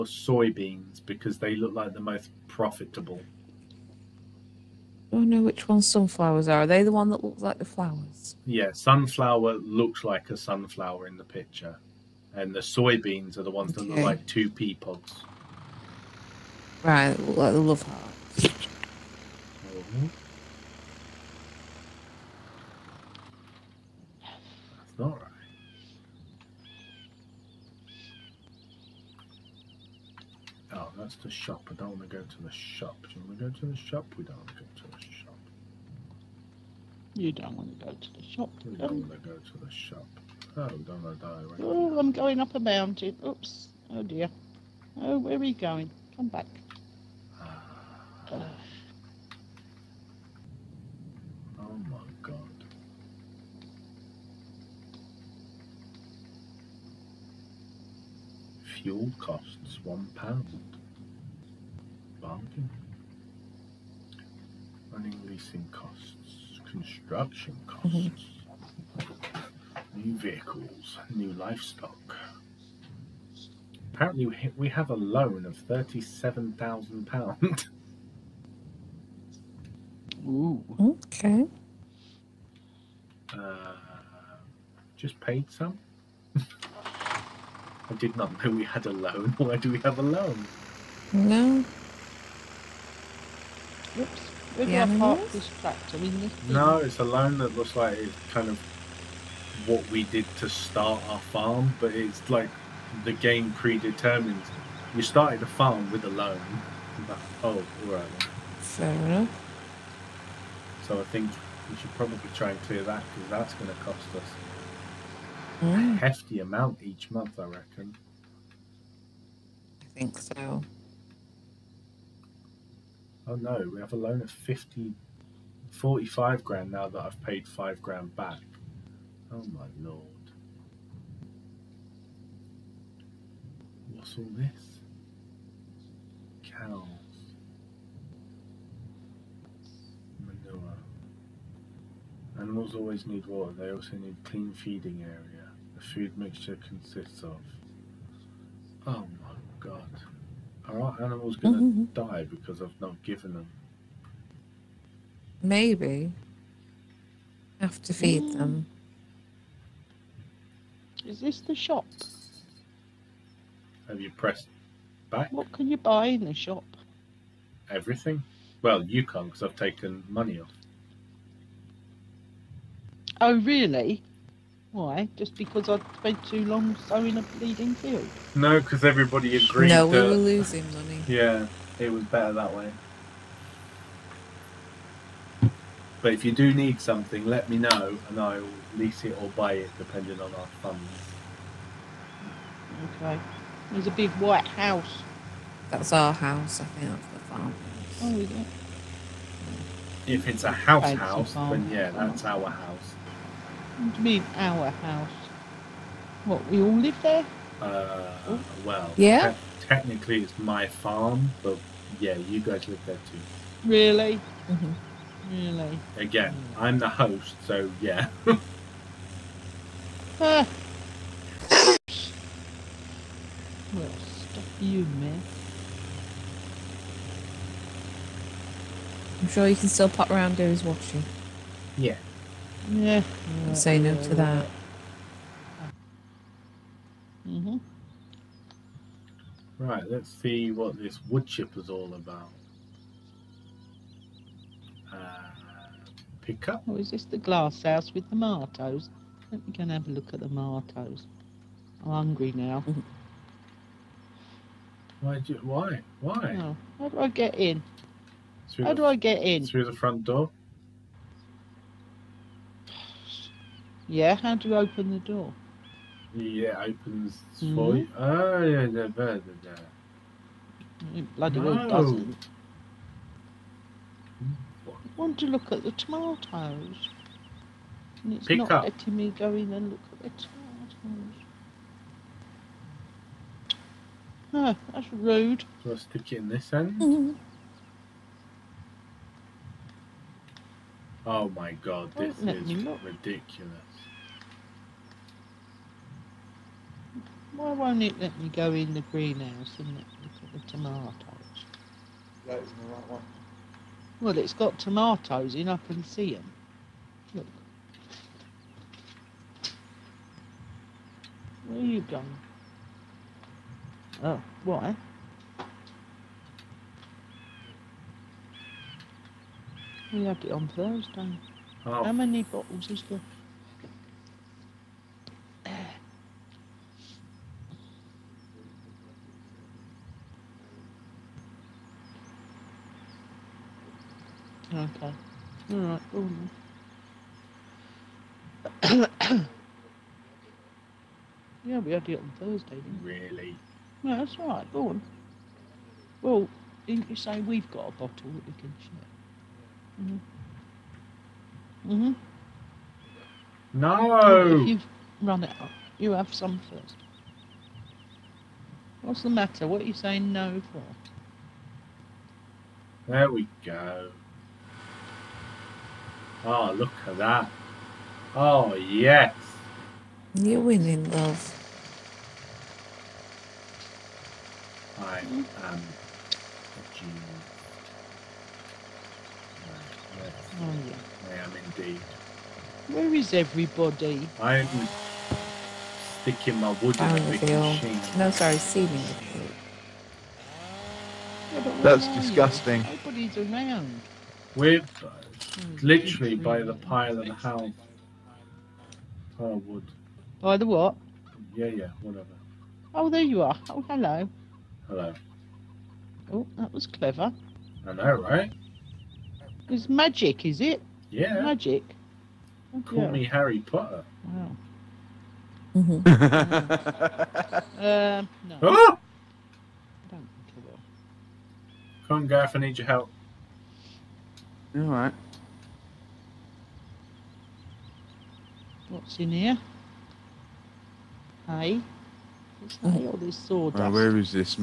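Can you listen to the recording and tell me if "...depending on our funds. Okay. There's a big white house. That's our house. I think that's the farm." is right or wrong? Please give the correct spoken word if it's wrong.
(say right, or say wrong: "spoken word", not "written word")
right.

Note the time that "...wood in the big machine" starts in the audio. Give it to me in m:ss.
6:26.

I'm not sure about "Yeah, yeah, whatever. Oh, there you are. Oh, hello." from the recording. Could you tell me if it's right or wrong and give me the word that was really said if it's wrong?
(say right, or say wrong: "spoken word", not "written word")
right.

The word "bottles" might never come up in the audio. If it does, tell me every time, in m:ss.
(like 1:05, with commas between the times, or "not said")
5:22, 5:47.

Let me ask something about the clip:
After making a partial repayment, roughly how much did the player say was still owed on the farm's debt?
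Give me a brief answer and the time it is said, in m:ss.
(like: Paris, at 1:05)
45,000 pounds, at 2:05.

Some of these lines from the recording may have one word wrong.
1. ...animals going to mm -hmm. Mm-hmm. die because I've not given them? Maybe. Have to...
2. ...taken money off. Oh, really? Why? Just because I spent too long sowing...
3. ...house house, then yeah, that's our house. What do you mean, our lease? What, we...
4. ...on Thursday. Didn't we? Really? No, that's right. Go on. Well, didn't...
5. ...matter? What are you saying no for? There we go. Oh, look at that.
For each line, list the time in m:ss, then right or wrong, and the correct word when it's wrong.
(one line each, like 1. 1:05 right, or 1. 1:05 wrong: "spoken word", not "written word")
1. 2:31 right
2. 2:49 right
3. 3:20 wrong: "house", not "lease"
4. 5:41 right
5. 5:59 right.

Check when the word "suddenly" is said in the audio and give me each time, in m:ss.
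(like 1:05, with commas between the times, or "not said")
not said.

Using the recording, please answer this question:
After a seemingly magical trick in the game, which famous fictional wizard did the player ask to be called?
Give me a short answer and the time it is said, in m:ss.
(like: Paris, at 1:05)
Harry Potter, at 6:53.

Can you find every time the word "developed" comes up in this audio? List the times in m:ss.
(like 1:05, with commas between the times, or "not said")
not said.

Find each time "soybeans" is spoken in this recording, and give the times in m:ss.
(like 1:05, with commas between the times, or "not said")
0:00, 0:12.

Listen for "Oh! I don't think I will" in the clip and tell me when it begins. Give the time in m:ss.
6:58.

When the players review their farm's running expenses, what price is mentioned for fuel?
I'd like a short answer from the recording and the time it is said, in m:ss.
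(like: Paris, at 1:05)
1 pound, at 0:58.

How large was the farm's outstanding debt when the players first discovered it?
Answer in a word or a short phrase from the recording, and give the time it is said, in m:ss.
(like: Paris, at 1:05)
37,000 pounds, at 1:15.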